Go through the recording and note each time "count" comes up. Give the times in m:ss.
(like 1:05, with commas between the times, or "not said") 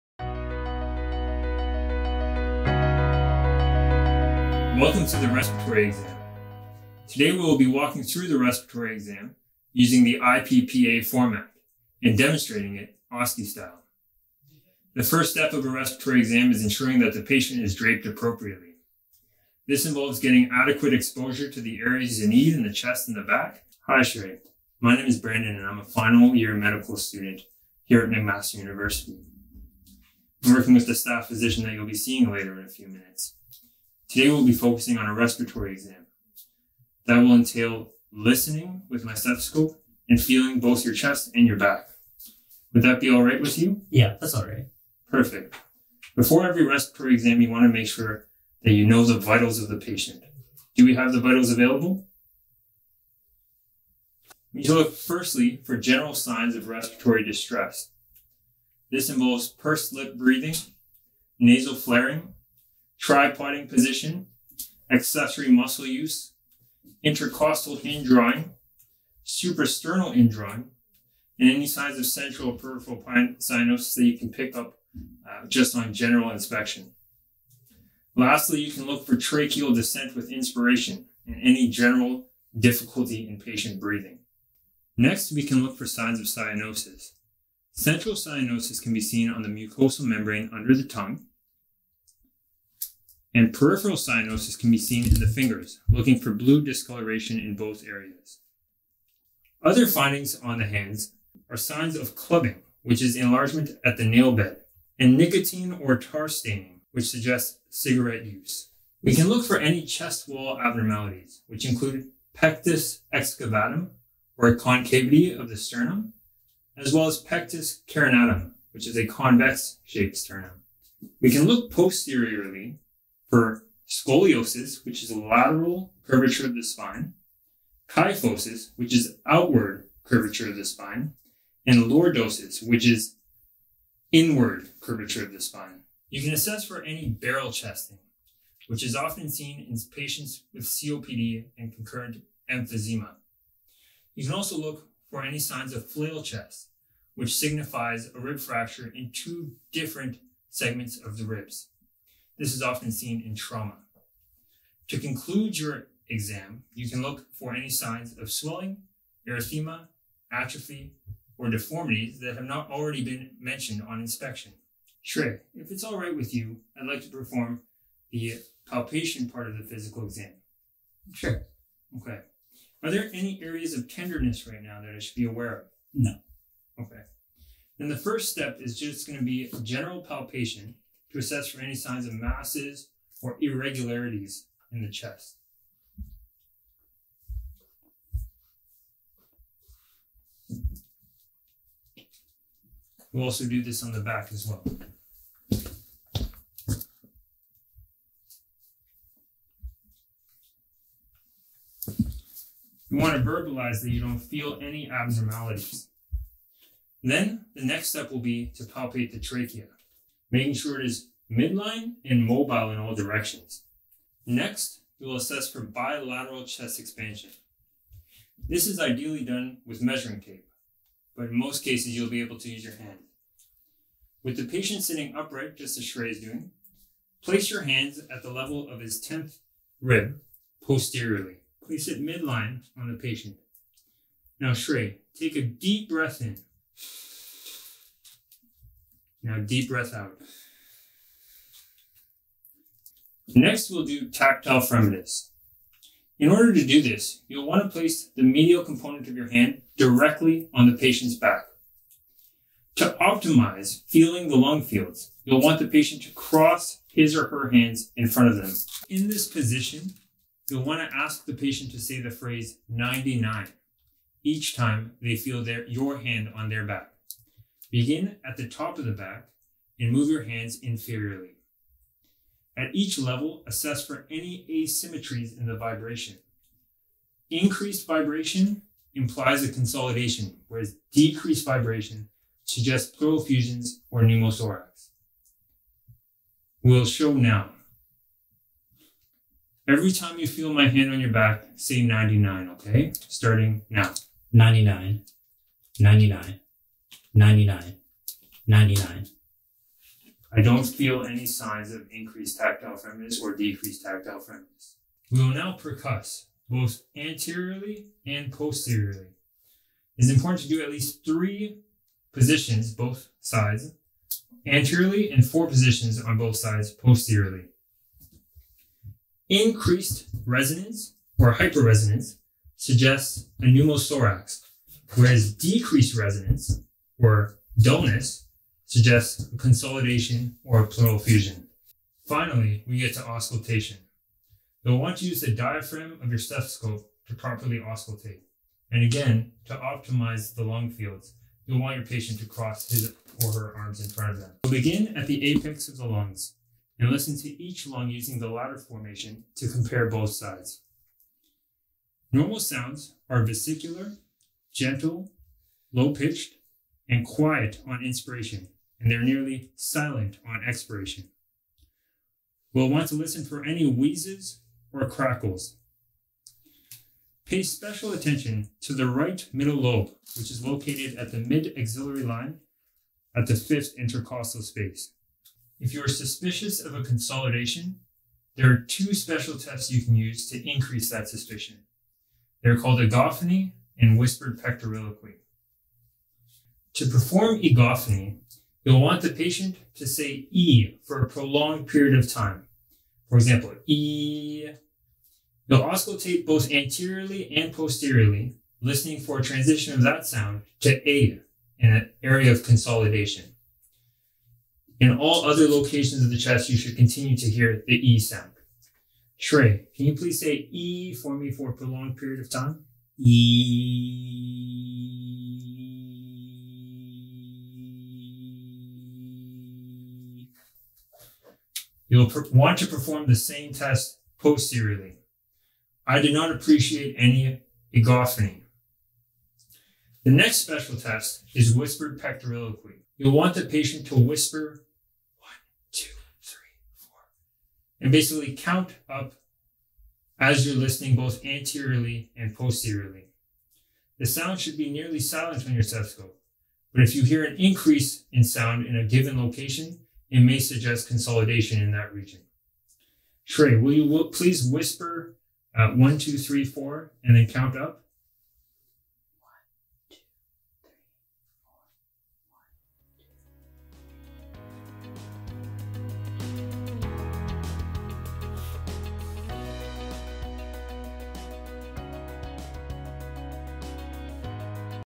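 7:18, 7:37.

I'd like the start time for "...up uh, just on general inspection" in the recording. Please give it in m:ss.
1:14.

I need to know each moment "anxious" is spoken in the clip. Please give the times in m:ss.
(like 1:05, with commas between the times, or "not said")
not said.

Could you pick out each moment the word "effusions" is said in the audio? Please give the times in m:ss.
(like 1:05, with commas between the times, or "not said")
4:43, 5:30.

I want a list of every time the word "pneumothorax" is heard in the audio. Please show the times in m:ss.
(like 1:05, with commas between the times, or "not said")
4:44, 5:23.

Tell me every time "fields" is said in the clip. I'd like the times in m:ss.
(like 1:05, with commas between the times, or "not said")
4:14, 5:40.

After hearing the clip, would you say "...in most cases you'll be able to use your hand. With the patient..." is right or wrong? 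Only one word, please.
right.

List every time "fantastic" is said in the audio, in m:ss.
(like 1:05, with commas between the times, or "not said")
not said.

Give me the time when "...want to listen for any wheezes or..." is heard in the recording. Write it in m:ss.
6:02.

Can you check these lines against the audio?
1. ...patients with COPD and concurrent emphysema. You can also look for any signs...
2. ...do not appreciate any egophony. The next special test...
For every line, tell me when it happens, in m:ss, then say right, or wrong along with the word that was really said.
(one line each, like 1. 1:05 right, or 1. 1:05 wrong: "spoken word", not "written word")
1. 2:19 right
2. 7:06 right.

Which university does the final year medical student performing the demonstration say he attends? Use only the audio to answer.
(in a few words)
McMaster University.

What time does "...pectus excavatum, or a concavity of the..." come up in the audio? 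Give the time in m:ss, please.
1:52.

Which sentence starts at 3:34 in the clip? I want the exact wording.
Next, we will assess for bilateral chest expansion.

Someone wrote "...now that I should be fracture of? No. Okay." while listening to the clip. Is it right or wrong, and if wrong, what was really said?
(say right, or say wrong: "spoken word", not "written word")
wrong: "aware", not "fracture".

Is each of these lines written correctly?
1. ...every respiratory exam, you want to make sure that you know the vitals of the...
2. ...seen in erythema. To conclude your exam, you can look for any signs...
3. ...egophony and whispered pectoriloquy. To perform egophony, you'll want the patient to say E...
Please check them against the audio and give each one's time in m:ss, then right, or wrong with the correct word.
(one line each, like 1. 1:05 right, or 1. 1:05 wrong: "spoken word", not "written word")
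1. 0:46 right
2. 2:32 wrong: "trauma", not "erythema"
3. 6:22 right.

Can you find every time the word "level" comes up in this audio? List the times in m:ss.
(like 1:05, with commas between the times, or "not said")
3:48, 4:32.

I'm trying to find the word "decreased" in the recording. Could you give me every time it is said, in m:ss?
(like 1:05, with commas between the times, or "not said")
4:40, 5:03, 5:25.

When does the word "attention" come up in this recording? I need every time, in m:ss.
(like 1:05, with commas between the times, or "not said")
6:07.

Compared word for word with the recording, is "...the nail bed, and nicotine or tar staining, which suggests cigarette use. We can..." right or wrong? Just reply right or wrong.
right.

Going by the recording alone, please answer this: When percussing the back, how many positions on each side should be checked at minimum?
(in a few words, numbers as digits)
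4.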